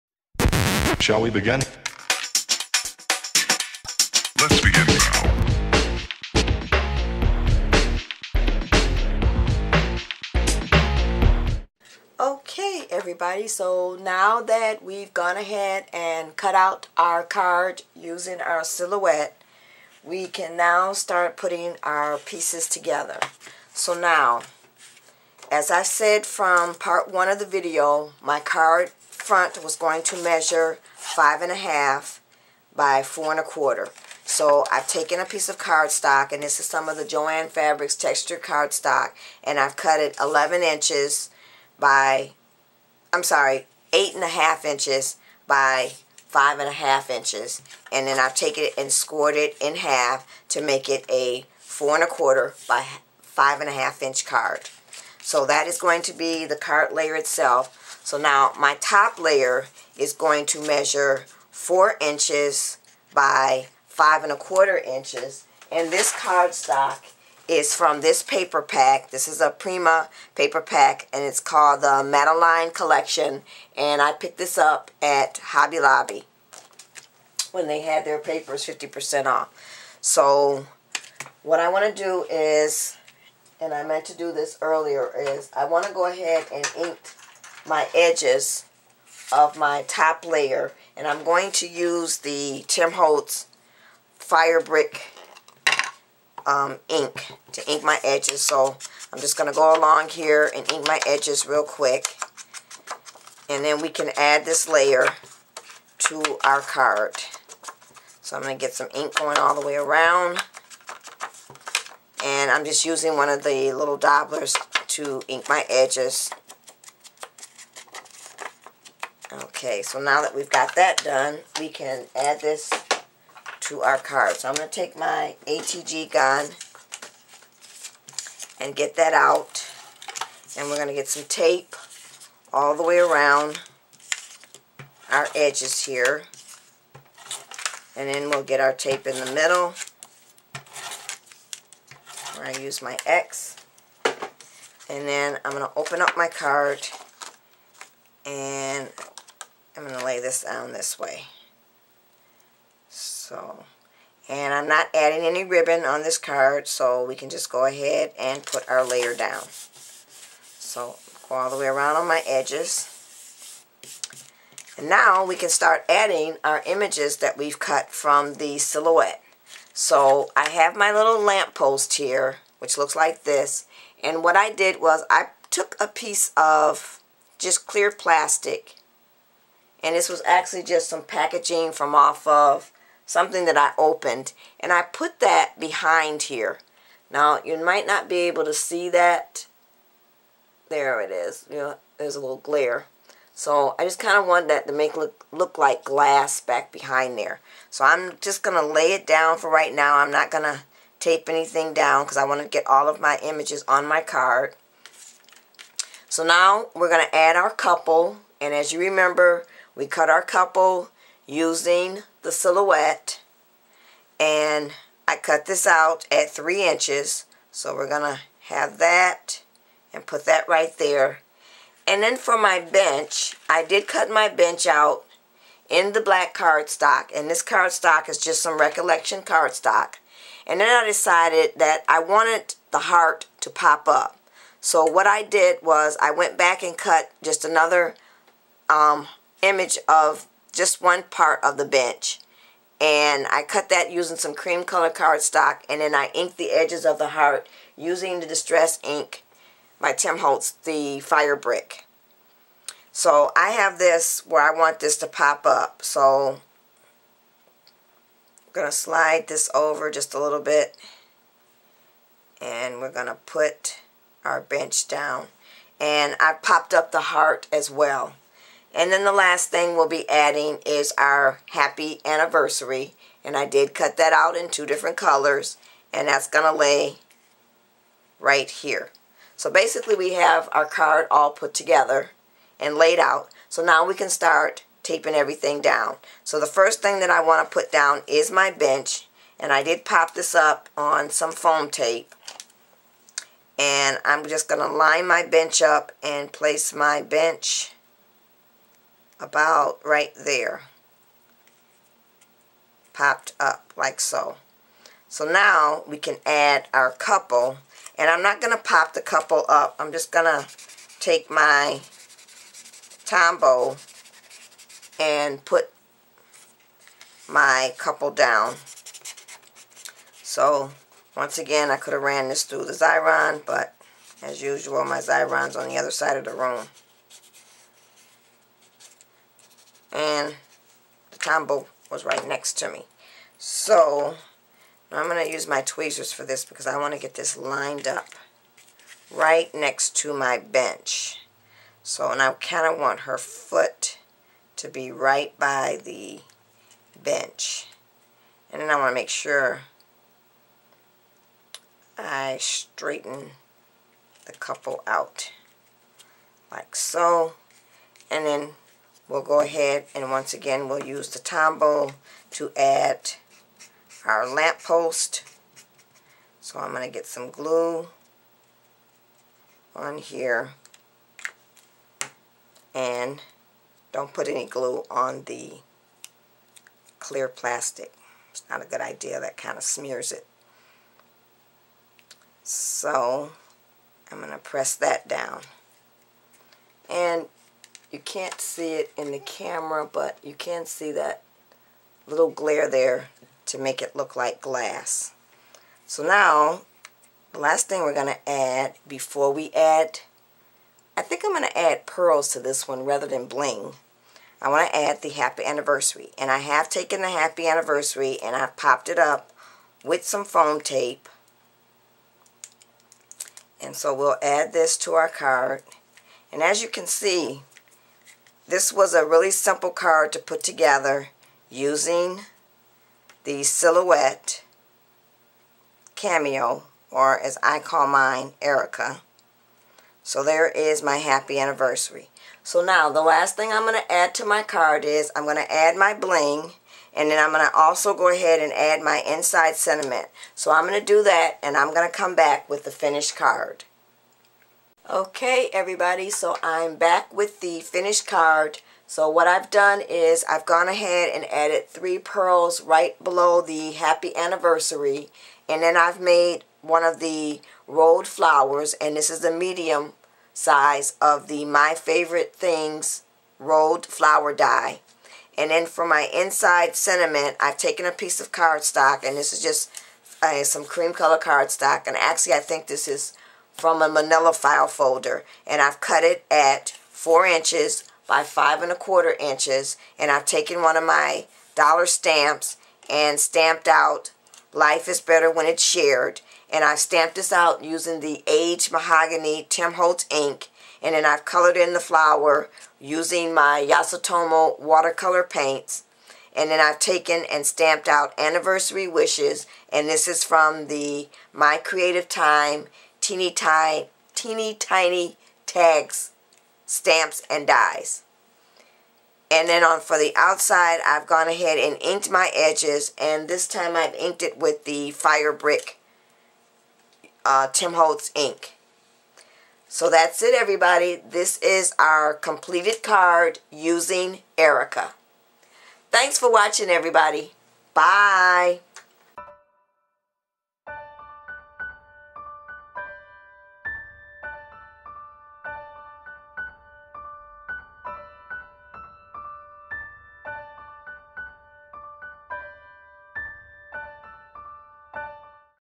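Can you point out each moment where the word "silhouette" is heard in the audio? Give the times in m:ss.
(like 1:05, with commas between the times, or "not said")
0:18, 2:48, 3:32, 7:03.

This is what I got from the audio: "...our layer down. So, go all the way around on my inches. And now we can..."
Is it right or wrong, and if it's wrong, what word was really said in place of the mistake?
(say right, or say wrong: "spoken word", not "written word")
wrong: "edges", not "inches".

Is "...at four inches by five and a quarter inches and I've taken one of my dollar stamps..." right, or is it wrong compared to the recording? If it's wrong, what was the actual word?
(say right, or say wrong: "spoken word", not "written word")
right.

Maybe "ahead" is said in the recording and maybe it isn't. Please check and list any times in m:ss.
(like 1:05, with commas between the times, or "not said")
0:15, 1:26, 2:37, 5:59, 7:18, 7:30, 8:31.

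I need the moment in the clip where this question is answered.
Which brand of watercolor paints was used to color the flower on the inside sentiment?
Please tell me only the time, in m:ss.
8:13.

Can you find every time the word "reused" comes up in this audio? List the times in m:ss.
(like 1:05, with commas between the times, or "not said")
not said.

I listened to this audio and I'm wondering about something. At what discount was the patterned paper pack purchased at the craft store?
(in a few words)
50%.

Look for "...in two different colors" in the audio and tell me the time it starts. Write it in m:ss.
4:34.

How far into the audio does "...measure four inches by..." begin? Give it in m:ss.
1:00.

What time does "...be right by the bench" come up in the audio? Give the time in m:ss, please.
5:44.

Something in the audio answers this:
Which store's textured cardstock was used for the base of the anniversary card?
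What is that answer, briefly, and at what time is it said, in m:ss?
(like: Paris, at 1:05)
Joann Fabrics, at 0:37.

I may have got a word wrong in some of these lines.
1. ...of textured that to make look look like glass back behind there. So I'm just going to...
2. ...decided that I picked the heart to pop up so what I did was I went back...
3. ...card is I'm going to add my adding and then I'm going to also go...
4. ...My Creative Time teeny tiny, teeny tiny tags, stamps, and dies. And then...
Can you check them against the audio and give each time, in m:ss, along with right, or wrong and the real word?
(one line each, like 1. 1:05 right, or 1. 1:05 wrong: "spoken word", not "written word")
1. 3:14 wrong: "wanted", not "textured"
2. 3:50 wrong: "wanted", not "picked"
3. 7:14 wrong: "bling", not "adding"
4. 8:21 right.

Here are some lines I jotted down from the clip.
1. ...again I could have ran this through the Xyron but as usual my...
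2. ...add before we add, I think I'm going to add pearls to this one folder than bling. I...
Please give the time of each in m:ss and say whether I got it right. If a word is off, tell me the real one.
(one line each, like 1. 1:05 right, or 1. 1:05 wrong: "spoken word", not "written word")
1. 5:21 right
2. 6:38 wrong: "rather", not "folder".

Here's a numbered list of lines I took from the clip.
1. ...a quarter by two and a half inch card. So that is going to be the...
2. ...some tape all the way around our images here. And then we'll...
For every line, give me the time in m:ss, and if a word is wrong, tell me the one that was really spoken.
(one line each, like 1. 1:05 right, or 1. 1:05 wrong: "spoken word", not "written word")
1. 0:52 wrong: "five", not "two"
2. 2:11 wrong: "edges", not "images".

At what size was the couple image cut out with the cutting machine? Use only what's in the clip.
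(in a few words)
3 inches.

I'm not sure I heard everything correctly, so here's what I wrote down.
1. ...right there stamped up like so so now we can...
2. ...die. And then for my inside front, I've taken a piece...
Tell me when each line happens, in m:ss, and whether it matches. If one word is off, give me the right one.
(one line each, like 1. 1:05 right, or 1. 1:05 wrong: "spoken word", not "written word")
1. 4:59 wrong: "popped", not "stamped"
2. 7:44 wrong: "sentiment", not "front".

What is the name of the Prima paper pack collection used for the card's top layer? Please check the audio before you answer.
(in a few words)
Madeline Collection.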